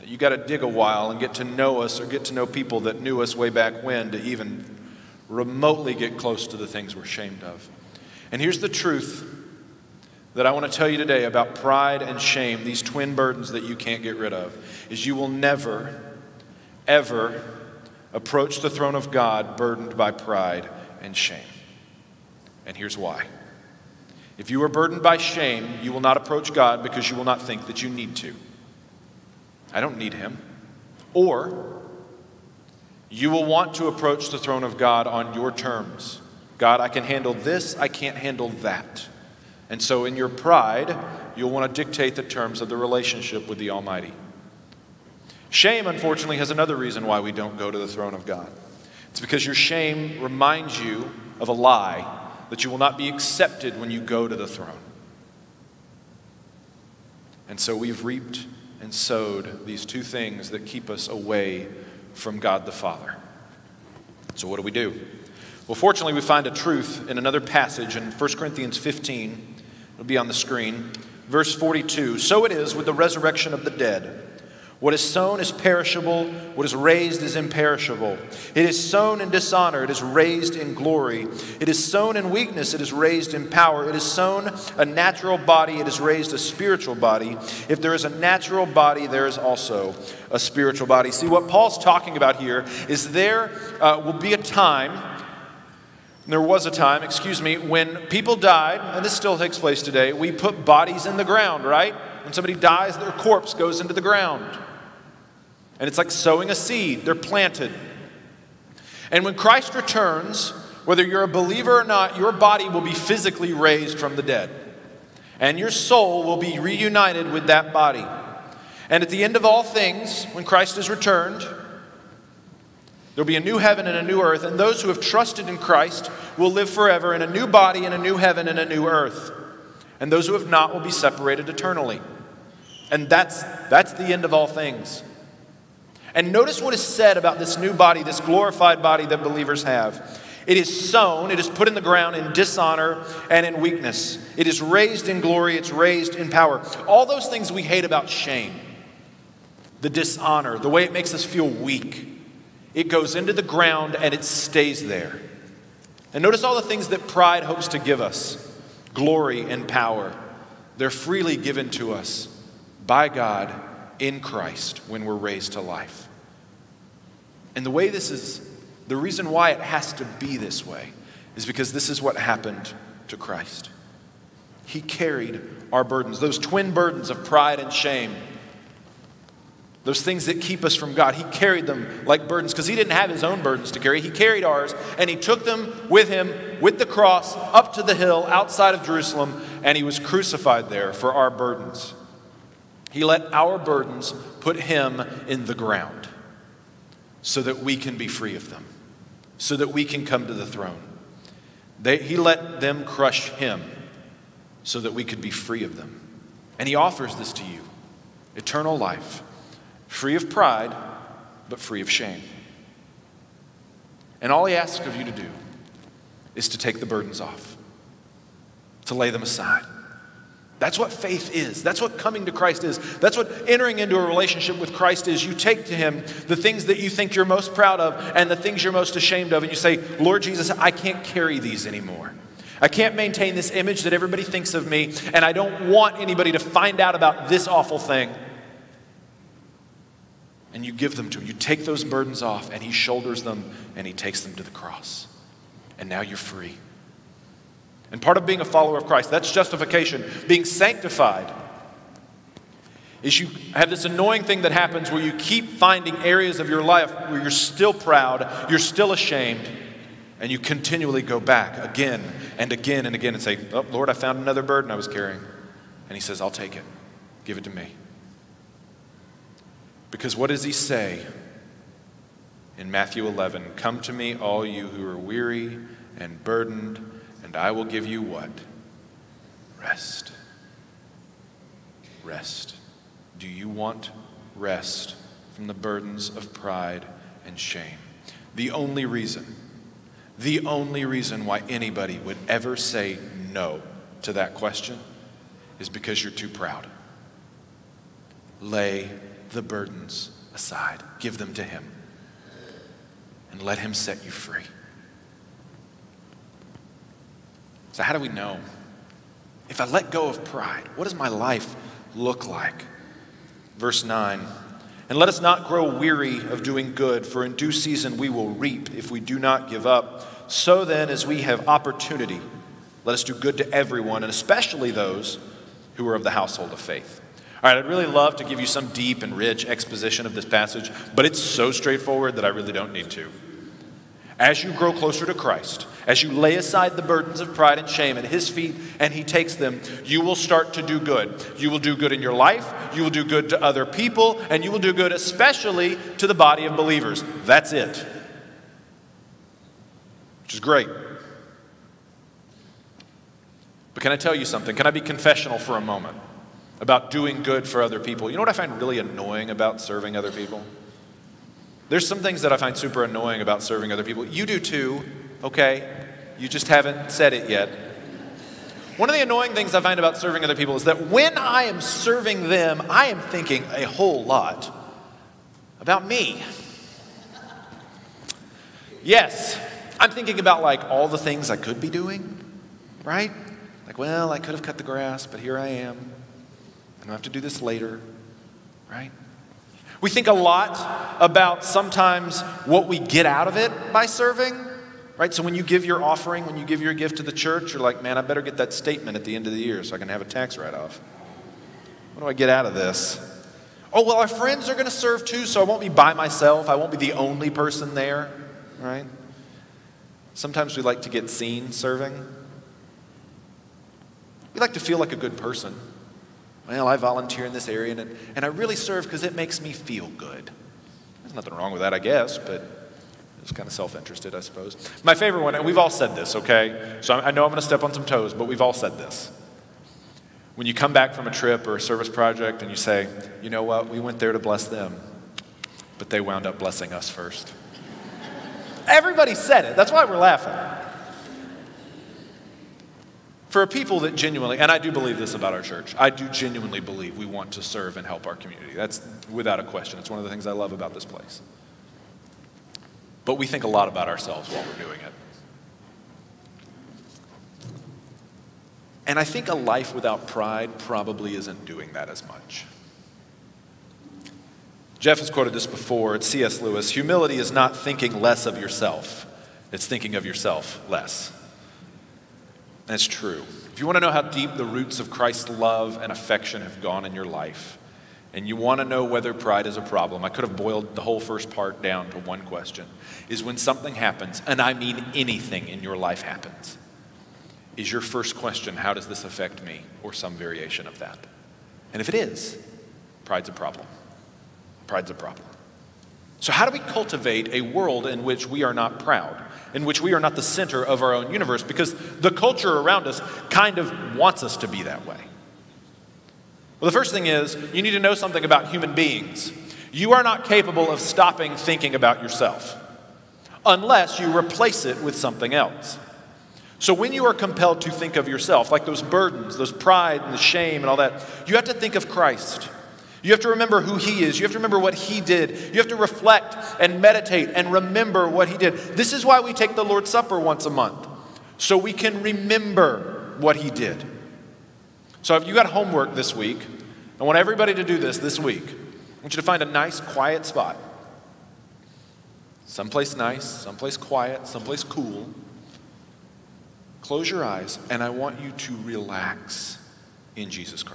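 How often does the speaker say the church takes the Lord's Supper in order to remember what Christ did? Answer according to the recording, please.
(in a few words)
Once a month.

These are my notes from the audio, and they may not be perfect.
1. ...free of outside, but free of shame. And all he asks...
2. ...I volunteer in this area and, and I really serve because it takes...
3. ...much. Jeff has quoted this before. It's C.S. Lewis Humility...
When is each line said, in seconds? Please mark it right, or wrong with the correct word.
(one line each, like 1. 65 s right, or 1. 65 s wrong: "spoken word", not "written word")
1. 209 s wrong: "pride", not "outside"
2. 416 s wrong: "makes", not "takes"
3. 462 s right.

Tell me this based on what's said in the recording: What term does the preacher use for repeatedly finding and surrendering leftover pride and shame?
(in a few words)
Sanctified.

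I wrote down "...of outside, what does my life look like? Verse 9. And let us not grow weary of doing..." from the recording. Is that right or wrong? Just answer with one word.
wrong.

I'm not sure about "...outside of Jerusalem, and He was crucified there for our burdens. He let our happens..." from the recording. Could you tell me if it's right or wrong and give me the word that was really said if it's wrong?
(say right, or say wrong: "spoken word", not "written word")
wrong: "burdens", not "happens".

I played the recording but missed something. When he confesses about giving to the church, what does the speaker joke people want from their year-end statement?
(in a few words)
A tax write off.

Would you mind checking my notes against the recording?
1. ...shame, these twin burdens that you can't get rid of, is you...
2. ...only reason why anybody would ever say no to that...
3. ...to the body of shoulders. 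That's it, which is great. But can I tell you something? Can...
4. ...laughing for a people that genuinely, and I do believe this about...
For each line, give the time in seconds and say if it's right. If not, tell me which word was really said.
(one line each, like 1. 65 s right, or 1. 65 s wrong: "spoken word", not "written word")
1. 12 s right
2. 290 s right
3. 345 s wrong: "believers", not "shoulders"
4. 439 s right.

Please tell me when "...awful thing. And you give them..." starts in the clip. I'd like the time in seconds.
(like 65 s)
237 s.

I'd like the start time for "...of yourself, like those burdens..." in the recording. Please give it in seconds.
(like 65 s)
517 s.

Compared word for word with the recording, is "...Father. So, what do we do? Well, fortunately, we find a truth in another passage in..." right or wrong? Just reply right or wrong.
right.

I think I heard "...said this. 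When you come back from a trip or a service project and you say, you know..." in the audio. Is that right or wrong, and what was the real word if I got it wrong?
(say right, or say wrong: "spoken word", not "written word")
right.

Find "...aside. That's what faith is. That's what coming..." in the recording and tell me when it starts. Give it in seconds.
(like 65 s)
219 s.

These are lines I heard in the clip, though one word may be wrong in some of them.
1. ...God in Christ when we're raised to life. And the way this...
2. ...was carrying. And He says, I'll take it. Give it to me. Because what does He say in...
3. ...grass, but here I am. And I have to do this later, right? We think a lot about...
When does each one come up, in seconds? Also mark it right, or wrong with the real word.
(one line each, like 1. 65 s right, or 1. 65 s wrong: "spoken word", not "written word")
1. 163 s right
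2. 264 s right
3. 384 s right.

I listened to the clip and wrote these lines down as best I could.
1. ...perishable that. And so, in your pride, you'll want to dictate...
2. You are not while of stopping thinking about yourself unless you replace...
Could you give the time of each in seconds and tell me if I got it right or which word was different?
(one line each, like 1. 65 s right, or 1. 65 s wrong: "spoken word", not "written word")
1. 38 s wrong: "handle", not "perishable"
2. 509 s wrong: "capable", not "while".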